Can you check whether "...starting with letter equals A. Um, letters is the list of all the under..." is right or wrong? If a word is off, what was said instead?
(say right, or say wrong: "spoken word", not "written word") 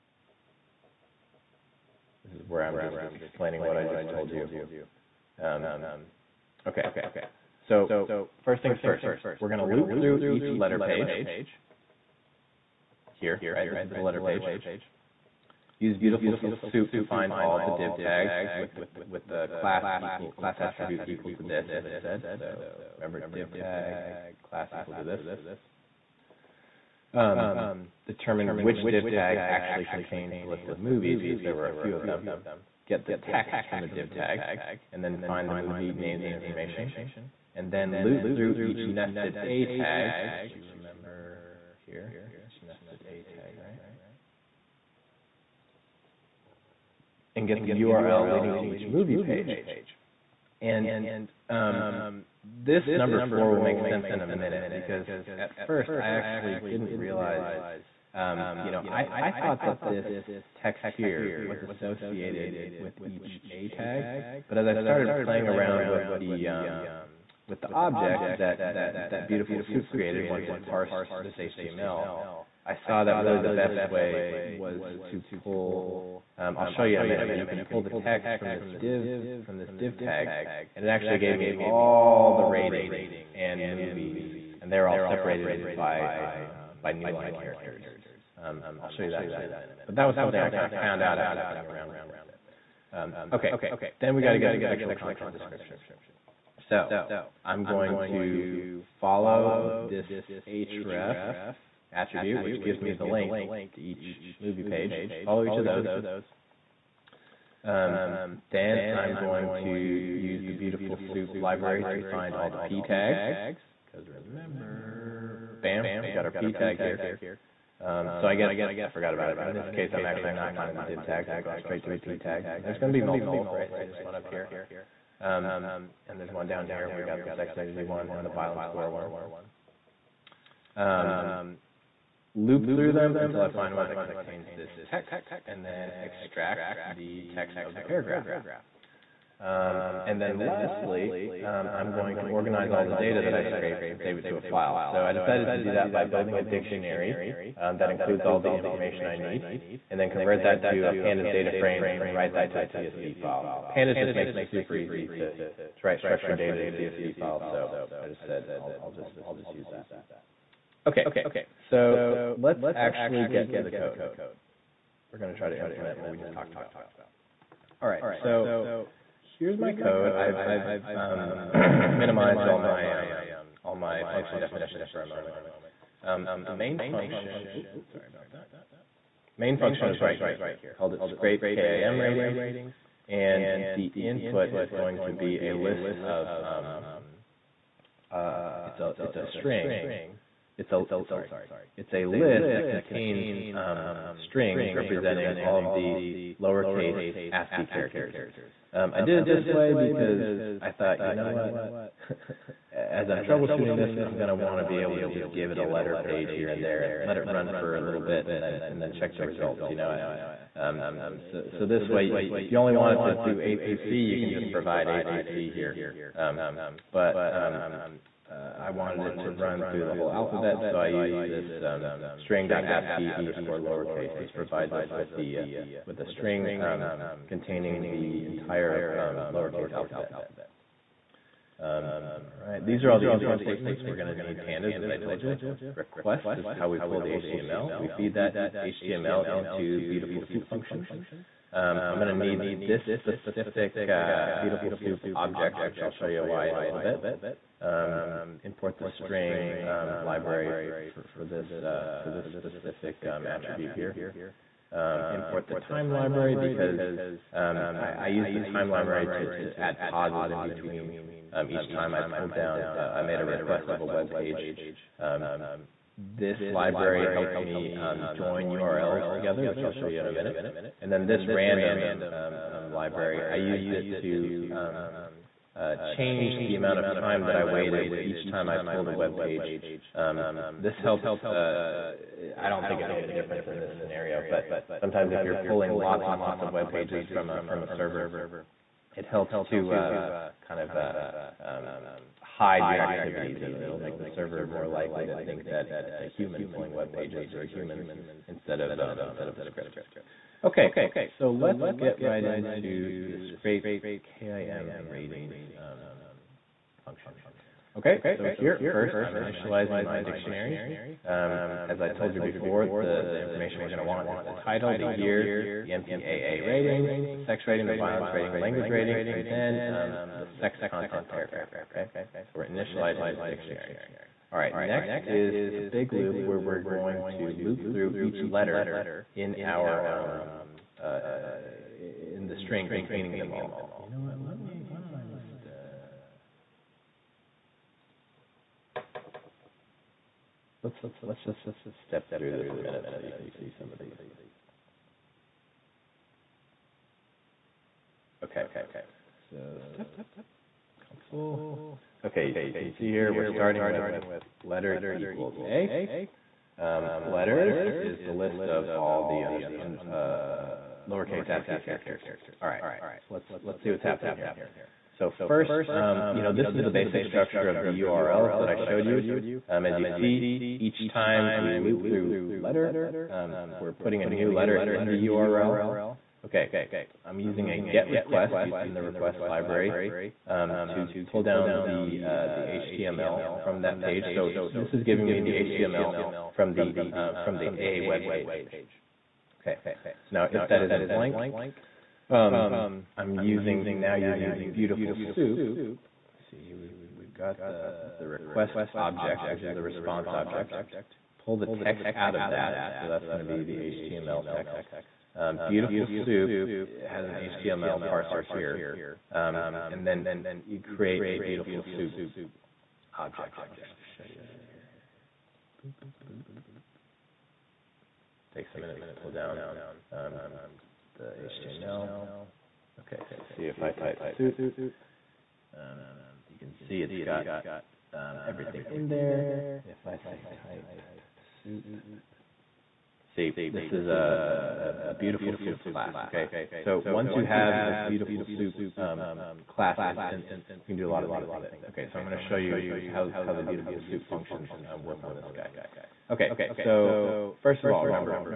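right.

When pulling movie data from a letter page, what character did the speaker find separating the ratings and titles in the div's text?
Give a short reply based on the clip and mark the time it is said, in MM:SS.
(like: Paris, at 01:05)
new line characters, at 01:26.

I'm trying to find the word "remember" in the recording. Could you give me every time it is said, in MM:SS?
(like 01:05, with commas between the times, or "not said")
00:22, 00:40, 01:54, 07:27.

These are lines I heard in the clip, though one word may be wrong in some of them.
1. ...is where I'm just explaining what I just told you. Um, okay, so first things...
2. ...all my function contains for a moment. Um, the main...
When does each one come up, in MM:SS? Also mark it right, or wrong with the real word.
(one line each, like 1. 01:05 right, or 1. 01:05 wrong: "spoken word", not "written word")
1. 00:02 right
2. 02:53 wrong: "definitions", not "contains".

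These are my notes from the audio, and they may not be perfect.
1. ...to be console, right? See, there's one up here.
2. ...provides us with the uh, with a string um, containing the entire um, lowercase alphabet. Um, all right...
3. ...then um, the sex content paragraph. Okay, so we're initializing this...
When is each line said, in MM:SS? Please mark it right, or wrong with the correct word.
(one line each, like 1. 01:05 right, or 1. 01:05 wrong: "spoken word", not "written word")
1. 02:02 wrong: "multiple", not "console"
2. 03:44 right
3. 05:19 right.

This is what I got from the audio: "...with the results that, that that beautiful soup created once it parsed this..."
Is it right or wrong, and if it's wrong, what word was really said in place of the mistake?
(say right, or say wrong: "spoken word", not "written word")
wrong: "objects", not "results".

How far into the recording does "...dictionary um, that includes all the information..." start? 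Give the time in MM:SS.
02:26.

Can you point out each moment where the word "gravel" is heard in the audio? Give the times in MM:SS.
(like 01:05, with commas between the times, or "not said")
not said.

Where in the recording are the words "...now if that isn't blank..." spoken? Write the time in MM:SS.
06:30.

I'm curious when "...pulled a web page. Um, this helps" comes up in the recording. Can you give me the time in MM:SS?
04:38.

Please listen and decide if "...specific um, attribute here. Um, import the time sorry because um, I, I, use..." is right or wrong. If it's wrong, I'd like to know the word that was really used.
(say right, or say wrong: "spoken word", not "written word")
wrong: "library", not "sorry".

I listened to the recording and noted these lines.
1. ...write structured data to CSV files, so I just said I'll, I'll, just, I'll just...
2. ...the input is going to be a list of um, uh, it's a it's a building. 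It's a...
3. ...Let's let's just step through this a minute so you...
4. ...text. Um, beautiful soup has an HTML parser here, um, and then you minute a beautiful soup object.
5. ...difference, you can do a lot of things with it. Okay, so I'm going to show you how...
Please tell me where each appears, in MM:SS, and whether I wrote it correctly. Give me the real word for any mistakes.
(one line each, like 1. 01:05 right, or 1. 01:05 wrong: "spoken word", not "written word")
1. 02:35 right
2. 03:03 wrong: "string", not "building"
3. 05:40 right
4. 06:44 wrong: "create", not "minute"
5. 07:19 wrong: "instance", not "difference".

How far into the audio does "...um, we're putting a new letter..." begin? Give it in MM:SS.
06:13.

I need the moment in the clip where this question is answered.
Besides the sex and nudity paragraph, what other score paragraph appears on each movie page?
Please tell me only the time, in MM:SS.
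02:08.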